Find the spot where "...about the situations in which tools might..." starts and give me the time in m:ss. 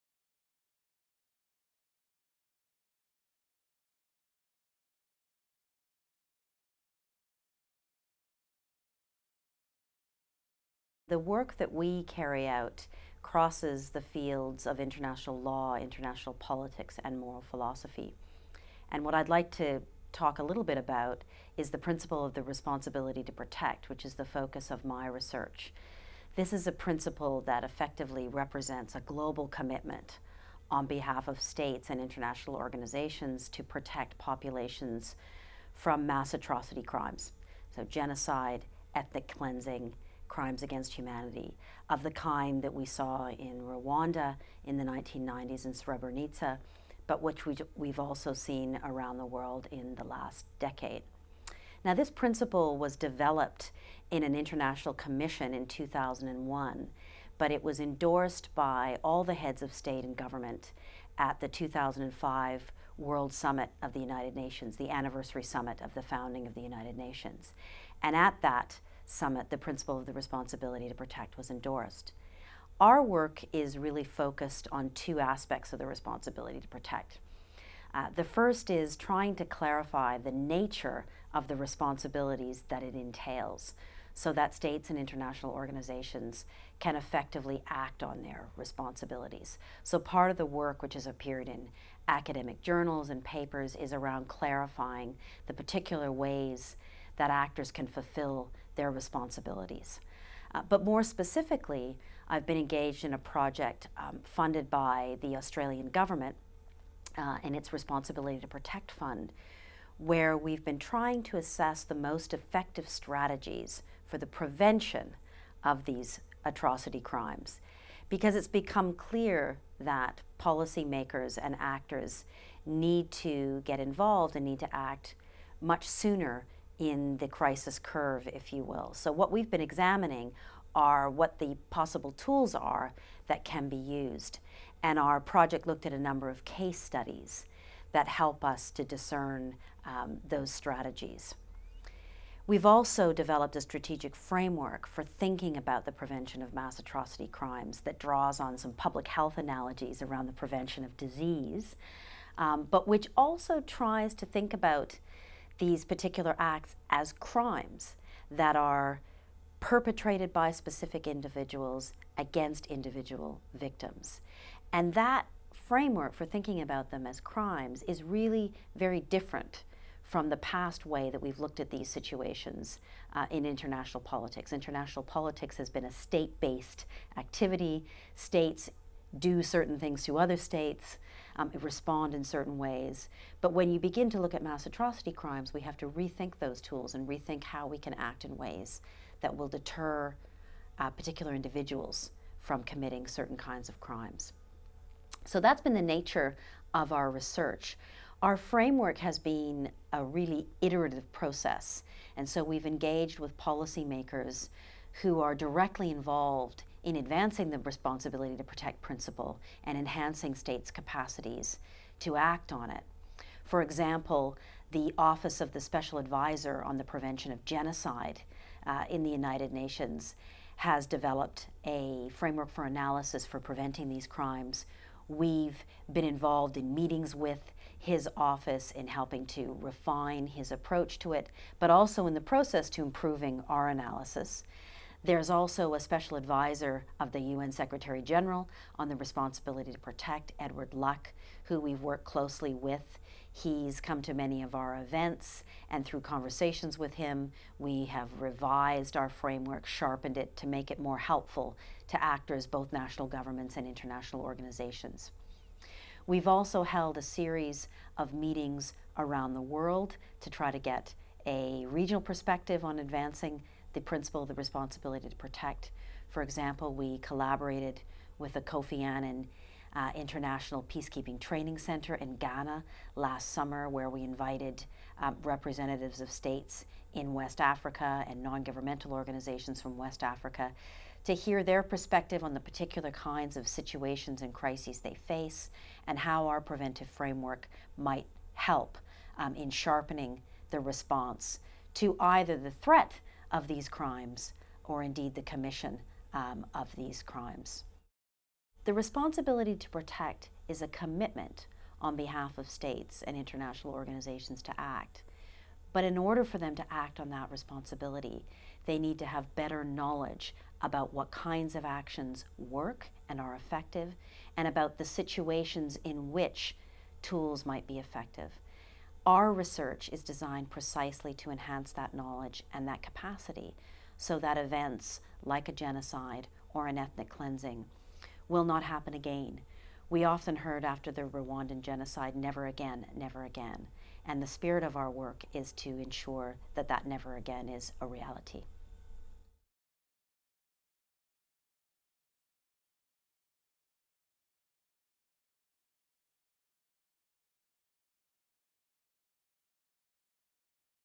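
5:14.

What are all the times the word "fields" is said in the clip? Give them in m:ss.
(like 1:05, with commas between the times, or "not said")
0:14.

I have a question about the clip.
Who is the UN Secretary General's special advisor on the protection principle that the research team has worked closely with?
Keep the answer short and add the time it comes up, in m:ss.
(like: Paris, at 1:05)
Edward Luck, at 4:00.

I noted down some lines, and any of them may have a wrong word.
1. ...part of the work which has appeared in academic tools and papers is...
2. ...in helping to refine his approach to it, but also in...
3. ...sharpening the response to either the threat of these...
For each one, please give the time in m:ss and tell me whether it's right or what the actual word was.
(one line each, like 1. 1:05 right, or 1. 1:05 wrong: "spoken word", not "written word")
1. 1:29 wrong: "journals", not "tools"
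2. 3:48 right
3. 4:49 right.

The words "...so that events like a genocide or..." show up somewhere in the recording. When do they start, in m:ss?
5:23.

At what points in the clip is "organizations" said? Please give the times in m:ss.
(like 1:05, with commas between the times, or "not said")
0:32, 1:25, 4:14, 4:38, 5:03.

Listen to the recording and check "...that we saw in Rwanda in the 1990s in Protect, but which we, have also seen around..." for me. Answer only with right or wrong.
wrong.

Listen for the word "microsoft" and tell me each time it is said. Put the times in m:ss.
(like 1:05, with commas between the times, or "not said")
not said.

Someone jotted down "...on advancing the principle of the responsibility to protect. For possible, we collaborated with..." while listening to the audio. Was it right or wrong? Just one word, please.
wrong.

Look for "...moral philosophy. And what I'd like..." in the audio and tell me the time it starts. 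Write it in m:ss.
0:17.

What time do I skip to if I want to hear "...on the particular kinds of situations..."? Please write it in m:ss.
4:42.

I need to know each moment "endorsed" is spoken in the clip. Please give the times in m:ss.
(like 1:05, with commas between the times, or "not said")
0:57, 1:11.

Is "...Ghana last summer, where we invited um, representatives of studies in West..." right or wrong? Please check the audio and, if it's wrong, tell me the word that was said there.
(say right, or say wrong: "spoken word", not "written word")
wrong: "states", not "studies".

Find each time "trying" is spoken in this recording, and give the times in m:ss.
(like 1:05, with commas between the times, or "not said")
1:18, 1:50.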